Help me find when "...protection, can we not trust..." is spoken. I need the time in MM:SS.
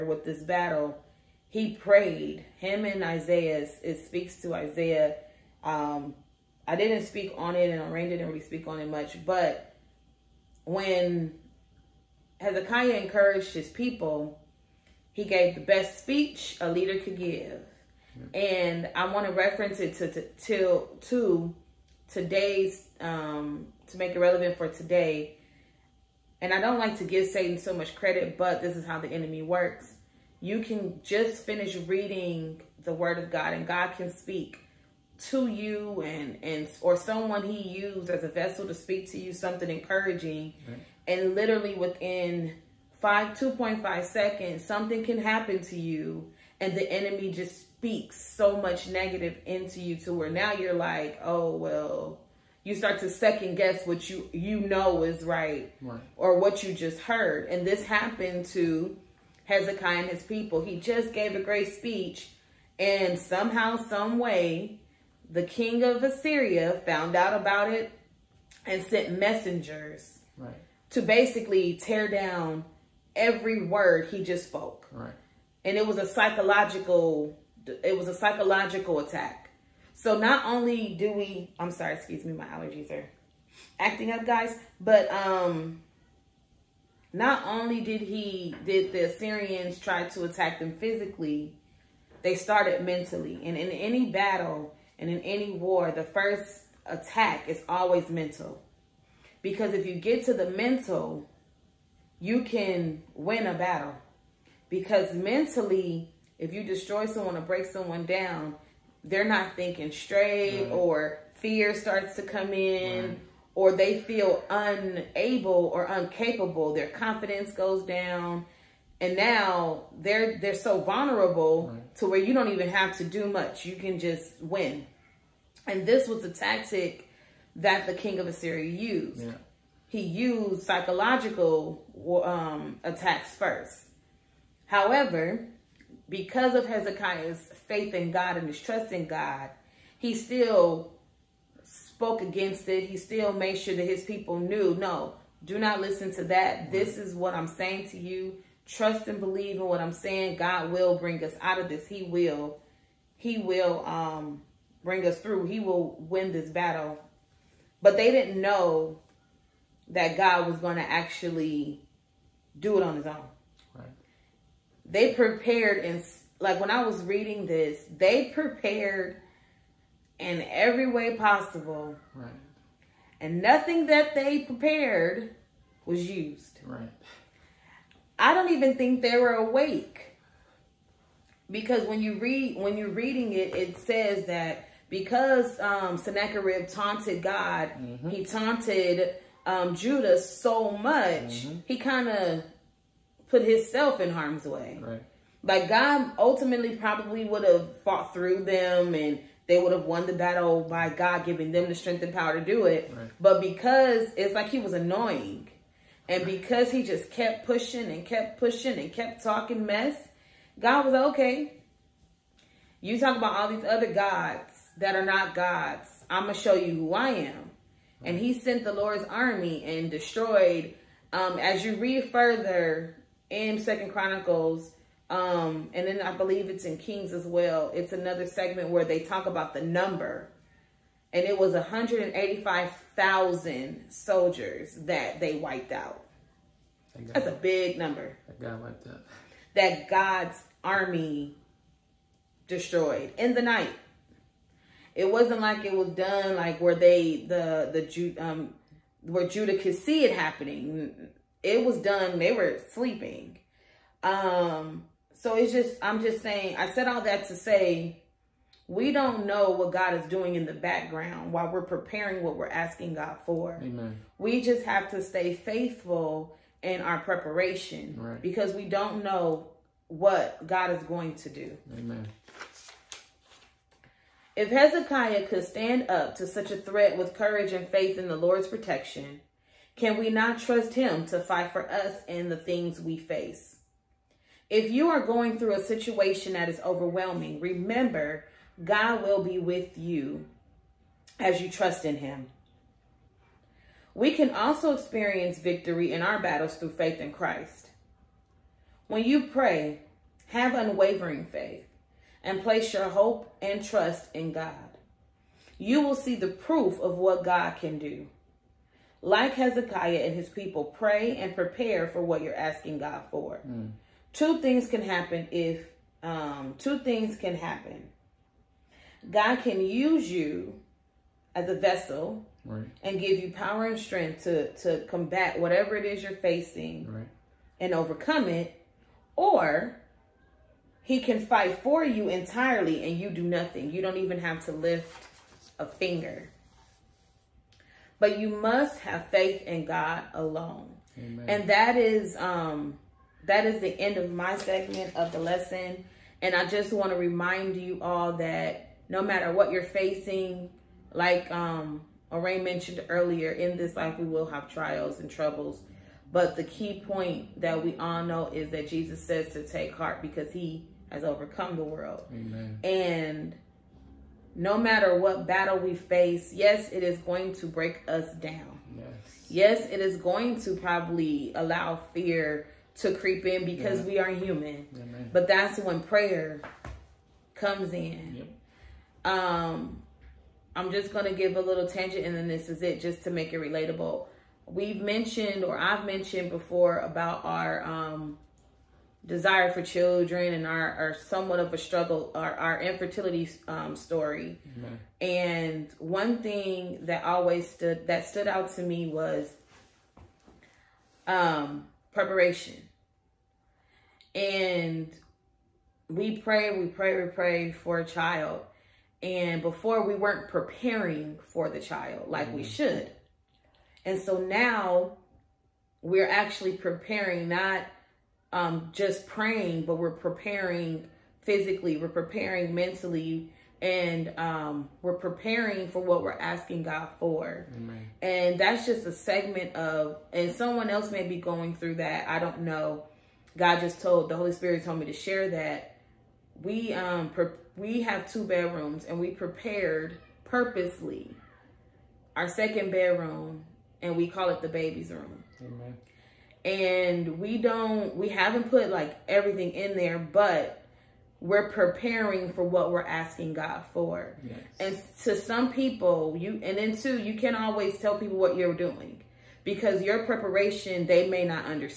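04:38.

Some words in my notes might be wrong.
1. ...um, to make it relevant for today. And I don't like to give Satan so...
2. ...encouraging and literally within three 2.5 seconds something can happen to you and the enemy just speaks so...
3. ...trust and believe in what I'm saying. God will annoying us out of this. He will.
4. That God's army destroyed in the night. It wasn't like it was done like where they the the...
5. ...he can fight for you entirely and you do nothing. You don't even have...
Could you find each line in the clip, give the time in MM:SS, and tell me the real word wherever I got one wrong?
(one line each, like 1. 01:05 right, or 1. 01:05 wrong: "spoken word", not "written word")
1. 00:22 right
2. 00:39 wrong: "five", not "three"
3. 02:28 wrong: "bring", not "annoying"
4. 03:59 right
5. 05:30 right.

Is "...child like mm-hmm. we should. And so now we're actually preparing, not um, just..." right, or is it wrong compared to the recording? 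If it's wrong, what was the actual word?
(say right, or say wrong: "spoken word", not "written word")
right.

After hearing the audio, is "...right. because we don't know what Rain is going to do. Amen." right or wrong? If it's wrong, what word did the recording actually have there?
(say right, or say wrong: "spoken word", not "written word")
wrong: "God", not "Rain".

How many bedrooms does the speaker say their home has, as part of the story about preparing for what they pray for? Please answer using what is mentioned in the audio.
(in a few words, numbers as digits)
2.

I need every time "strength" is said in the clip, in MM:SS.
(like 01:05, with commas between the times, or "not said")
03:21, 05:23.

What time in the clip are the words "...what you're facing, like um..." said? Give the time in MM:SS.
05:49.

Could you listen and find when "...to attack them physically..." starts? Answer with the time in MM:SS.
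01:30.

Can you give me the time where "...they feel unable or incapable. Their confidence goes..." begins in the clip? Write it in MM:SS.
01:53.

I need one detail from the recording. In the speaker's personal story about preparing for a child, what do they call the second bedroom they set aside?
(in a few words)
The baby's room.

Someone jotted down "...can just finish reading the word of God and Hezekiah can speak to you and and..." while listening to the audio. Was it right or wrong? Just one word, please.
wrong.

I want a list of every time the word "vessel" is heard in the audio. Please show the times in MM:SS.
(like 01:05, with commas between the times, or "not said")
00:38, 05:21.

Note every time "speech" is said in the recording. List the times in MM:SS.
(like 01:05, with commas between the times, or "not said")
00:15, 01:01.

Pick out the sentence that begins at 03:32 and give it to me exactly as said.
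You talk about all these other gods that are not gods.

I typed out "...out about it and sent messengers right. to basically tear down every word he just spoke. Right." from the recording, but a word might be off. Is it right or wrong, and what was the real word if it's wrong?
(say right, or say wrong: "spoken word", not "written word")
right.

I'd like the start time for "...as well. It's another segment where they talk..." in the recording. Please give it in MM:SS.
03:47.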